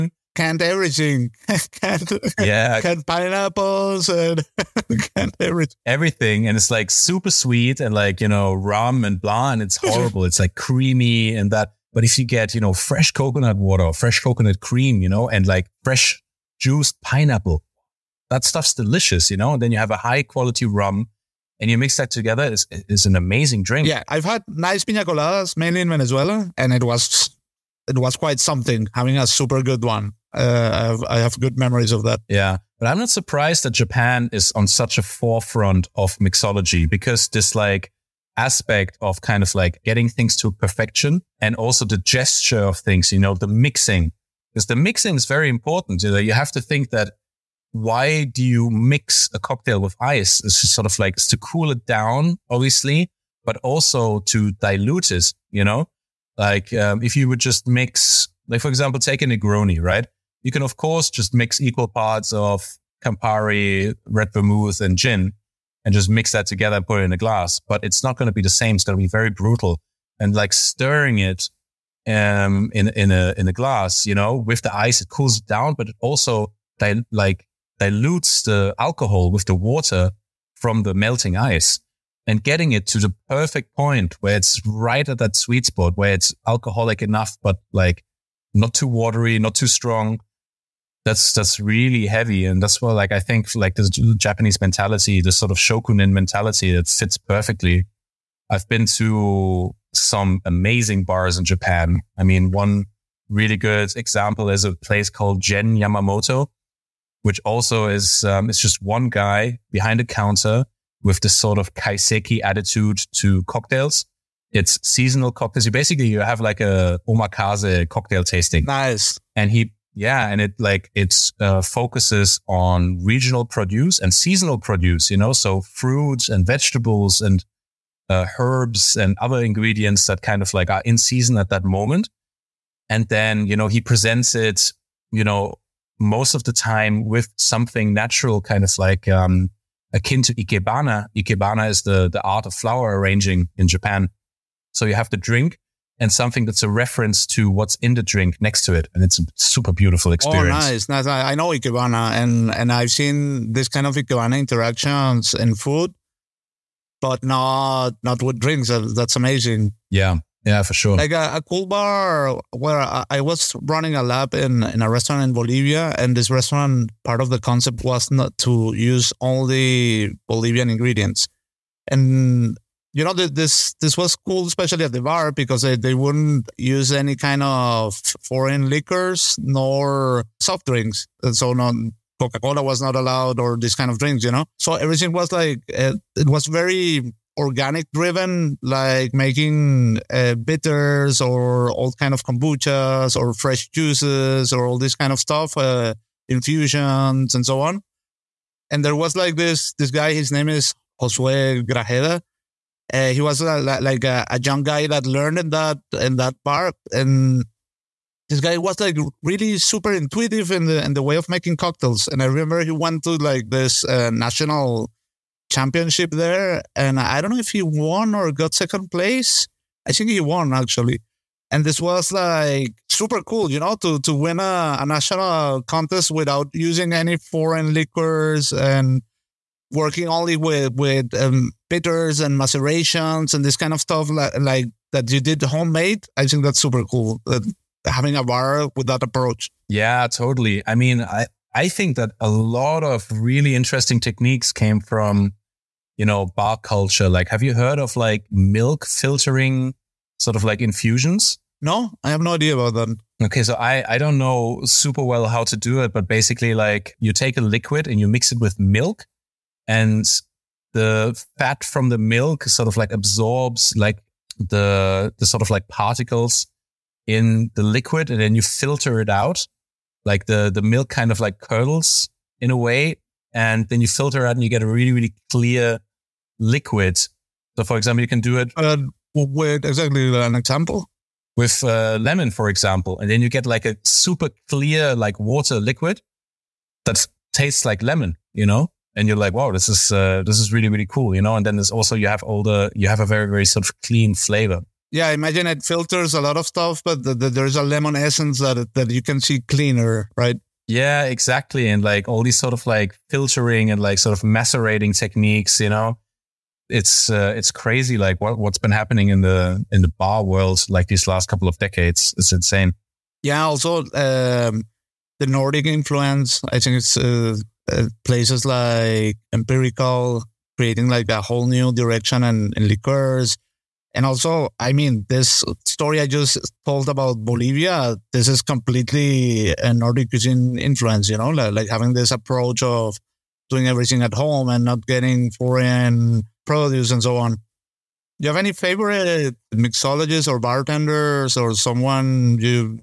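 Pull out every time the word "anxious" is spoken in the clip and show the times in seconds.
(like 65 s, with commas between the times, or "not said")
not said.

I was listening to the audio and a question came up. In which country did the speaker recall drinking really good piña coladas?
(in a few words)
Venezuela.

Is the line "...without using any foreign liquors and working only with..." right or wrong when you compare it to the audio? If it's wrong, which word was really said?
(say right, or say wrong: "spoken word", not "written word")
right.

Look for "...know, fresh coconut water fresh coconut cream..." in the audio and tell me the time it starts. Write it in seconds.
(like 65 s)
12 s.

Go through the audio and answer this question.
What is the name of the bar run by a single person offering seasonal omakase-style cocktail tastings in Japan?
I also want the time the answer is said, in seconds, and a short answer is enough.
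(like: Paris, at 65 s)
Gen Yamamoto, at 105 s.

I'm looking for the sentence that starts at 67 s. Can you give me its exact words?
But it's not going to be the same.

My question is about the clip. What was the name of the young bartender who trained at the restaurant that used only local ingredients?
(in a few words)
Josue Grajeda.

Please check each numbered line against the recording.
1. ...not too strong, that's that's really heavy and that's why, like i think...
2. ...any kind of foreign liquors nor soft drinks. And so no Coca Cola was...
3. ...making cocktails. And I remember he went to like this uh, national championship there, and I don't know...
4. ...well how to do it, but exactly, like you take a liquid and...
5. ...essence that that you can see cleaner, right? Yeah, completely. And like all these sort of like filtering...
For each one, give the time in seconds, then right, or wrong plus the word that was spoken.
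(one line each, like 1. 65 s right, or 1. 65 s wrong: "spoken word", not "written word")
1. 89 s right
2. 176 s right
3. 211 s right
4. 255 s wrong: "basically", not "exactly"
5. 297 s wrong: "exactly", not "completely".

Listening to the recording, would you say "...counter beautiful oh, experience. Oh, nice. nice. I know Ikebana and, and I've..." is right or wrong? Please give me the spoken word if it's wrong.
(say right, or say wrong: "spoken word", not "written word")
wrong: "super", not "counter".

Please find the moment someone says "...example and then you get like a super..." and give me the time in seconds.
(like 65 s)
282 s.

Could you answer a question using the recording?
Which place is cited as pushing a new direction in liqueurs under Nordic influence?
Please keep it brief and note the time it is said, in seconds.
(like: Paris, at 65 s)
Empirical, at 319 s.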